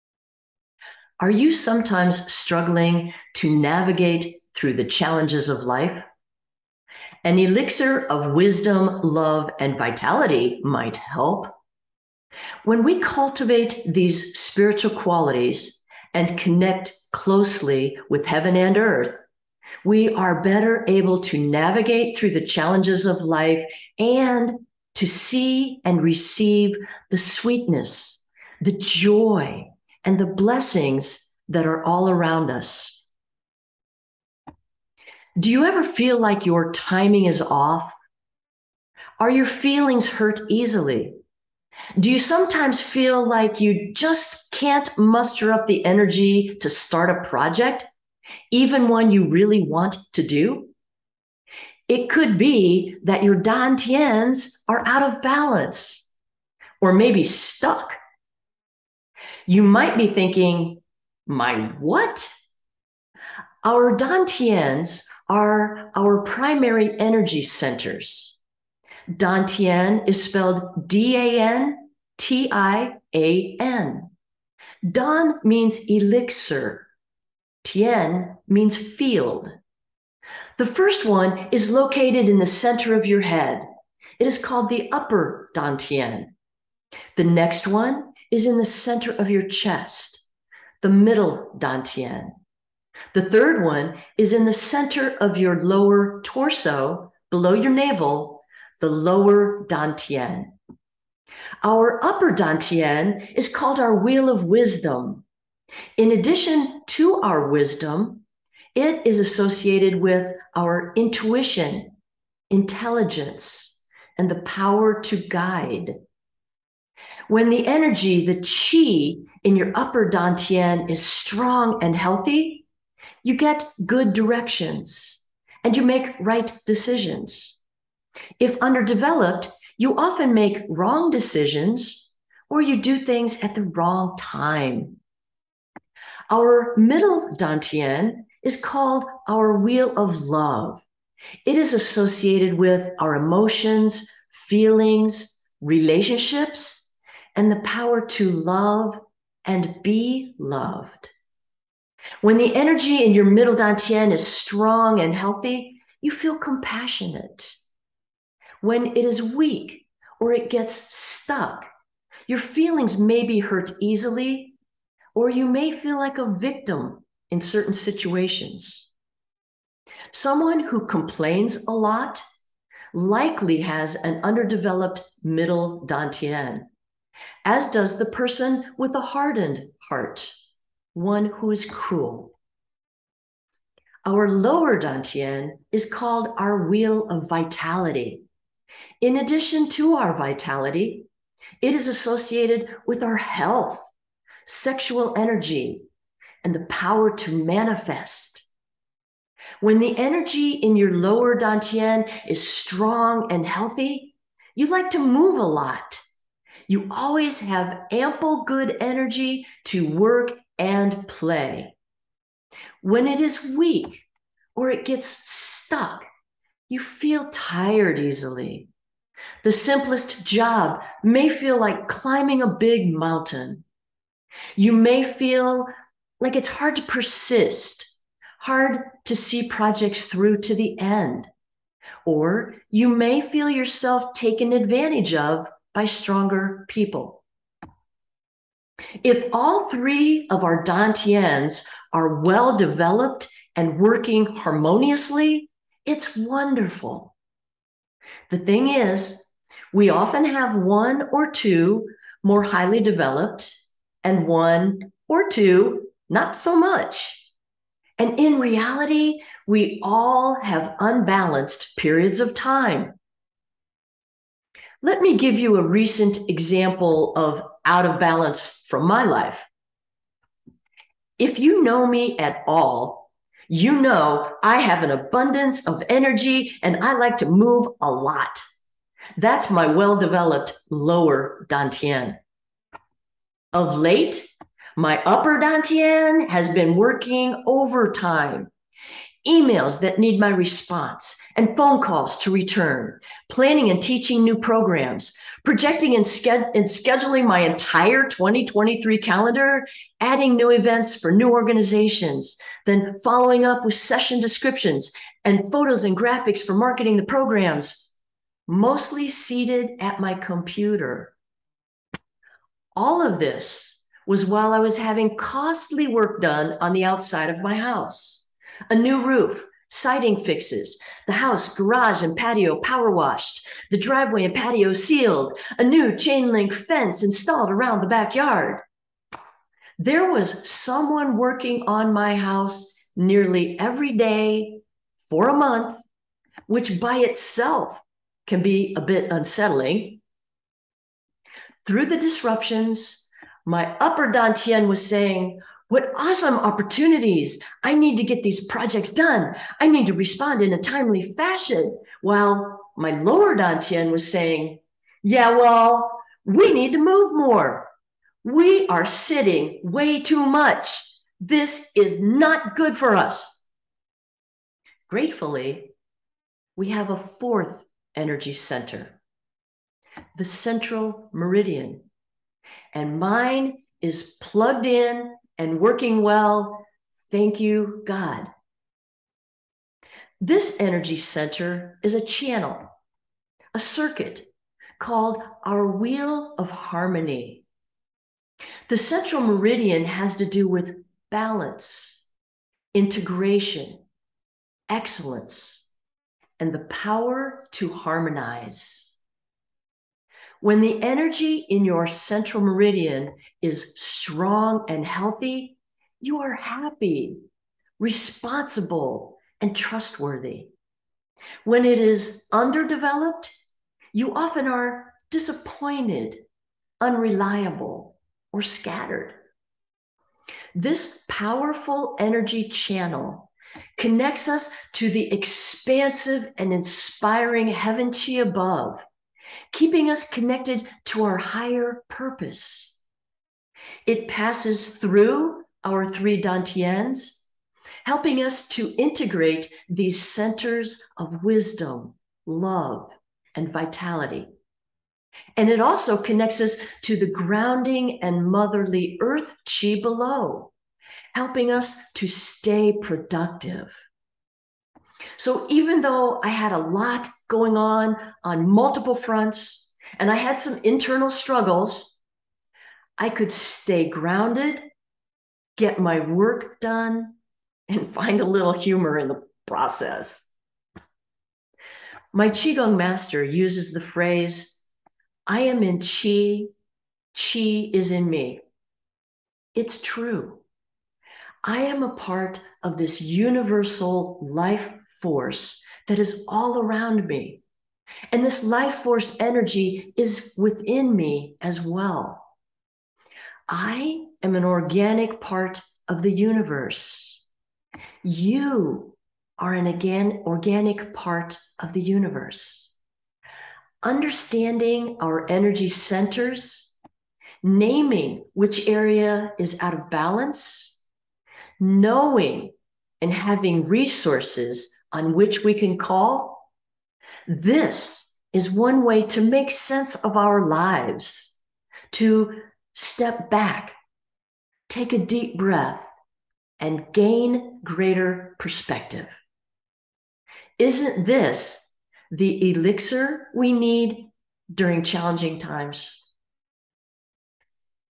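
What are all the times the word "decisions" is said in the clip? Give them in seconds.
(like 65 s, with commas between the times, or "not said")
126 s, 131 s.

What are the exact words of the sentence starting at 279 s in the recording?
That's my well developed lower Dantian.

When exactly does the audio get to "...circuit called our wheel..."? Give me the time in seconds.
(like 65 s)
383 s.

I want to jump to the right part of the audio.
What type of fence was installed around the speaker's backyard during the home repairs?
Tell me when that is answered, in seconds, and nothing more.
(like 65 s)
325 s.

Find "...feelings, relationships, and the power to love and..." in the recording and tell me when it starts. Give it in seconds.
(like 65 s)
144 s.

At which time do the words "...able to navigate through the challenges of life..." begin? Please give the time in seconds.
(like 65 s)
20 s.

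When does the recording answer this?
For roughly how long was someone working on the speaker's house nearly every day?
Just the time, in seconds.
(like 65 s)
335 s.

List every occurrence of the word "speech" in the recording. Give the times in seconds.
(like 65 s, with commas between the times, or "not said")
not said.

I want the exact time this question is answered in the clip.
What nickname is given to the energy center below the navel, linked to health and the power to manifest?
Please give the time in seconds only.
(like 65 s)
186 s.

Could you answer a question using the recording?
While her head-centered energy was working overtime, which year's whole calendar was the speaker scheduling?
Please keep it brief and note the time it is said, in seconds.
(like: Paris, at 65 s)
2023, at 298 s.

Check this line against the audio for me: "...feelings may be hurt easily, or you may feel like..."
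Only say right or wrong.
right.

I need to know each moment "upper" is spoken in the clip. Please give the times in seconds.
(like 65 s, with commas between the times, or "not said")
84 s, 102 s, 119 s, 285 s, 343 s.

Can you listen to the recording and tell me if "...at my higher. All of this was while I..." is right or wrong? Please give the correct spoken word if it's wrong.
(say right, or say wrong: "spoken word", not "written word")
wrong: "computer", not "higher".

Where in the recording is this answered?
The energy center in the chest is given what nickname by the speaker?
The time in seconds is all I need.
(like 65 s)
139 s.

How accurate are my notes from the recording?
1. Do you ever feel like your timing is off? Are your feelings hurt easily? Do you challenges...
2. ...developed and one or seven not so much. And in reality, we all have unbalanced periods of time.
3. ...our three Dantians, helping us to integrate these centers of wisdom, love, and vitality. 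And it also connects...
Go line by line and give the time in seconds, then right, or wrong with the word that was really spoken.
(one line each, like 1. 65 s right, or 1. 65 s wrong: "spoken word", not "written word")
1. 35 s wrong: "sometimes", not "challenges"
2. 252 s wrong: "two", not "seven"
3. 435 s right.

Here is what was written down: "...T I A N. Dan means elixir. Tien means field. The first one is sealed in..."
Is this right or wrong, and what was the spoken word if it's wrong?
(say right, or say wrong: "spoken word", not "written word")
wrong: "located", not "sealed".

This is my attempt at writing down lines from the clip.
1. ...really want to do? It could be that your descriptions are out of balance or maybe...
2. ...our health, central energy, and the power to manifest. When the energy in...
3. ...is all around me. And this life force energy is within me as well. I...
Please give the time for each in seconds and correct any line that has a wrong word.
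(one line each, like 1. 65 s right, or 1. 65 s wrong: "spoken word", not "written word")
1. 49 s wrong: "dantians", not "descriptions"
2. 193 s wrong: "sexual", not "central"
3. 485 s right.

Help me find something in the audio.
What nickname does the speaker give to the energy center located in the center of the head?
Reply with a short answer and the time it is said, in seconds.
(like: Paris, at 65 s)
Wheel of wisdom, at 104 s.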